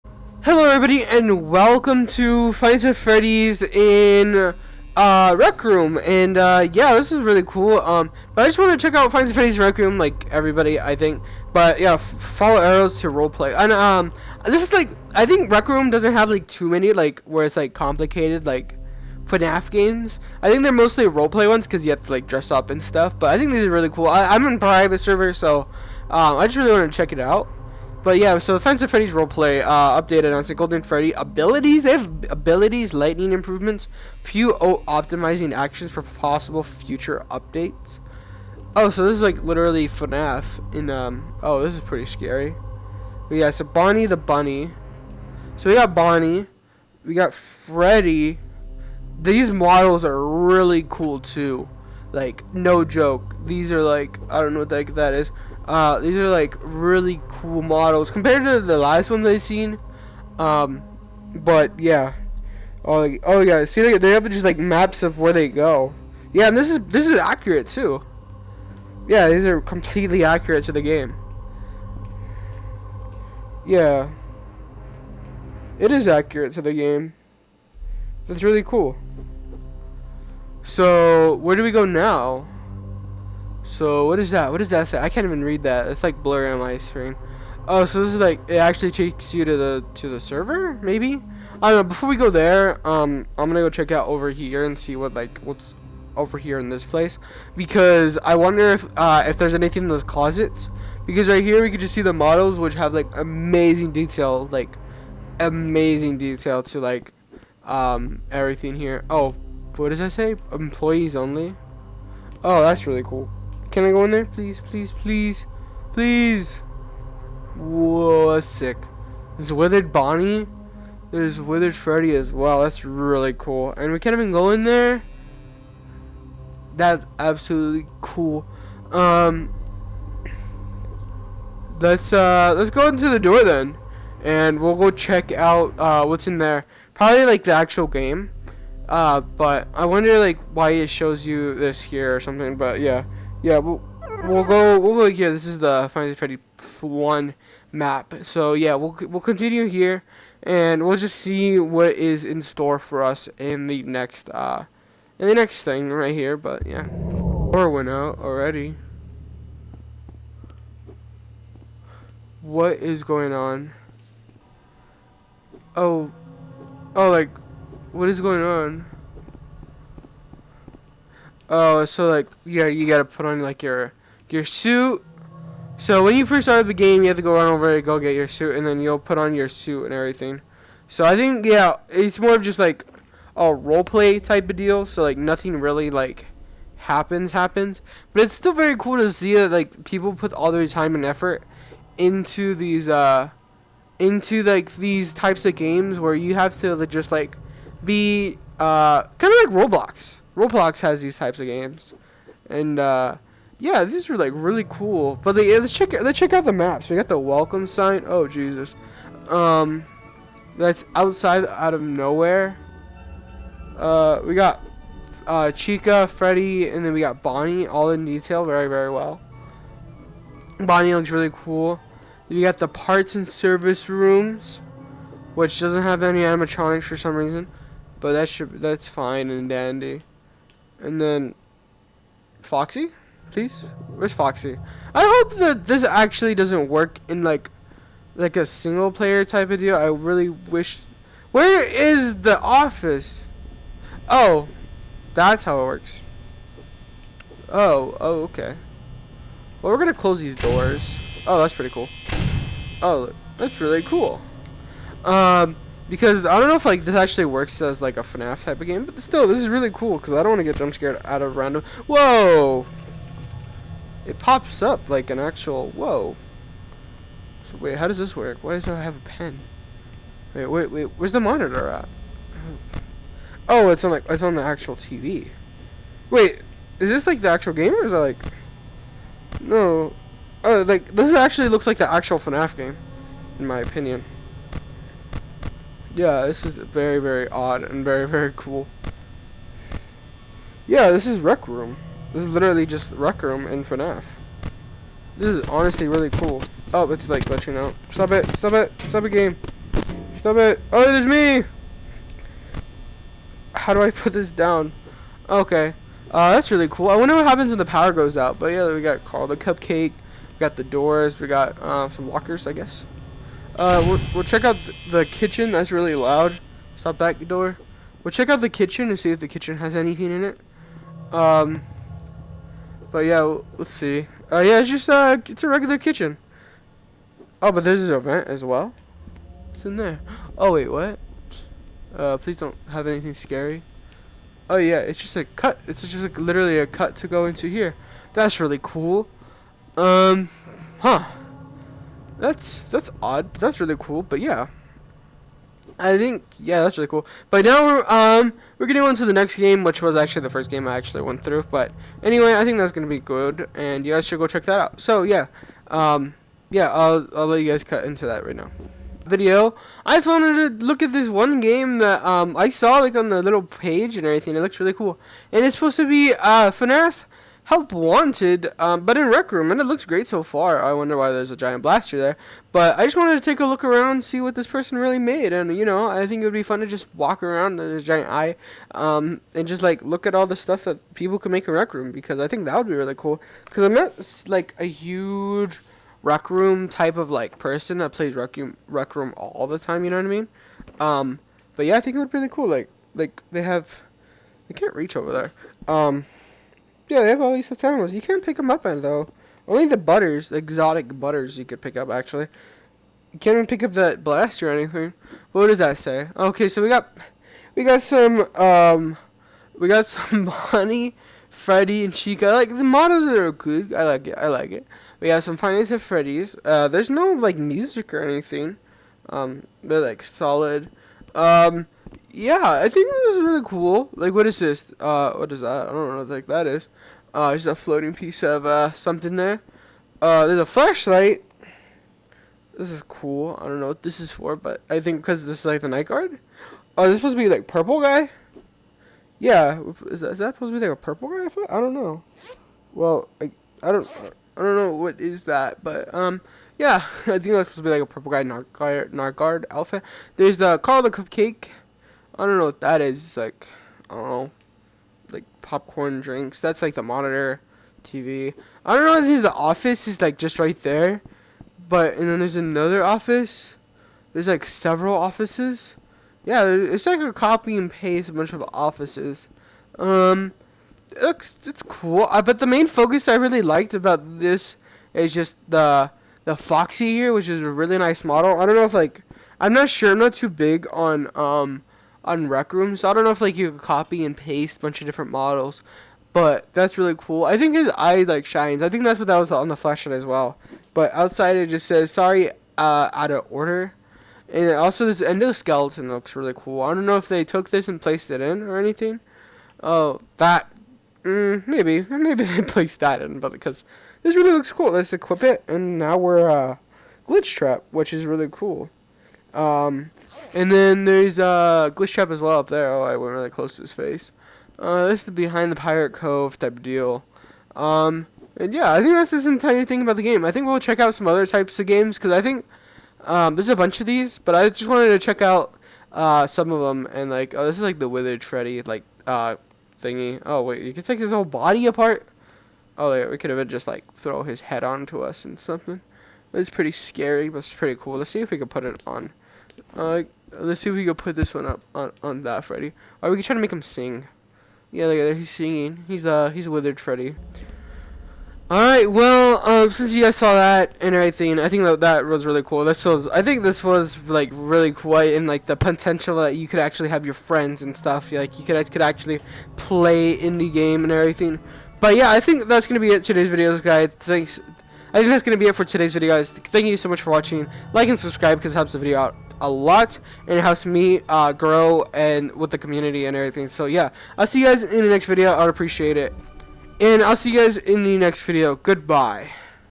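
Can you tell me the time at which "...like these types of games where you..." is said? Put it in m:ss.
3:14.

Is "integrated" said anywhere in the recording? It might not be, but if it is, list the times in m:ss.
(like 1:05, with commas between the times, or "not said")
not said.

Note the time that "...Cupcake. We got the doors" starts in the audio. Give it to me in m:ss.
5:09.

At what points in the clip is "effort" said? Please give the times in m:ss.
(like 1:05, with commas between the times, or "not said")
3:11.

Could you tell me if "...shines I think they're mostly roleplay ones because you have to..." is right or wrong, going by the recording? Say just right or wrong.
wrong.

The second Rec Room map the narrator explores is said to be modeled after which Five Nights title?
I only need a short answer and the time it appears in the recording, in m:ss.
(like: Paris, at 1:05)
FNAF Help Wanted, at 6:06.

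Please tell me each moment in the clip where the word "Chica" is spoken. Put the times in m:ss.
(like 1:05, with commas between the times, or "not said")
3:35, 6:51.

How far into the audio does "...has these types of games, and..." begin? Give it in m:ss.
3:20.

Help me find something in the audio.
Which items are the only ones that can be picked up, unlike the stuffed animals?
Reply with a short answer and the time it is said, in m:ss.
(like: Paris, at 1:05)
Exotic butters, at 6:40.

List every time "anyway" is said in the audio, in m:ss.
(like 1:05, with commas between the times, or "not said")
5:52.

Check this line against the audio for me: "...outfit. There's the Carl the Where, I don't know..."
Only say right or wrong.
wrong.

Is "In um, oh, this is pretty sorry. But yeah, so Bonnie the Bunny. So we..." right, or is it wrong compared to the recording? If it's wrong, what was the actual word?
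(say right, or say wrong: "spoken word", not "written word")
wrong: "scary", not "sorry".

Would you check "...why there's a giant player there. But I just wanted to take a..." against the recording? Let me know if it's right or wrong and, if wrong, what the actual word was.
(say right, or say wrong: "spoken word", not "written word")
wrong: "blaster", not "player".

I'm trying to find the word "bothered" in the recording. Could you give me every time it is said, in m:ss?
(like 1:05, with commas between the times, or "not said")
not said.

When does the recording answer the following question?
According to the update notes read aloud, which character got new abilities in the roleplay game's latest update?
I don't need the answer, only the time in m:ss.
0:30.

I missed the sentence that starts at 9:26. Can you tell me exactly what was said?
Thank you so much for watching.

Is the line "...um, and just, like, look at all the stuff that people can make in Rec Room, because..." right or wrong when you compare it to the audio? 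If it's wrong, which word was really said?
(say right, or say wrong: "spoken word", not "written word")
right.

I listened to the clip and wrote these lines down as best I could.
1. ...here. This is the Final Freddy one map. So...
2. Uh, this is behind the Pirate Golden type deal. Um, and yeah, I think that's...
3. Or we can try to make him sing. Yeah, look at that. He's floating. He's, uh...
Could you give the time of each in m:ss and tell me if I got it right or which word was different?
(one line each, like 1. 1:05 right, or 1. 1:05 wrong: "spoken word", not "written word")
1. 2:25 right
2. 8:34 wrong: "Cove", not "Golden"
3. 9:03 wrong: "singing", not "floating".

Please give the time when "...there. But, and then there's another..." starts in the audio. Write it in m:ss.
7:40.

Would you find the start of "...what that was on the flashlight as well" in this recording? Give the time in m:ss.
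8:08.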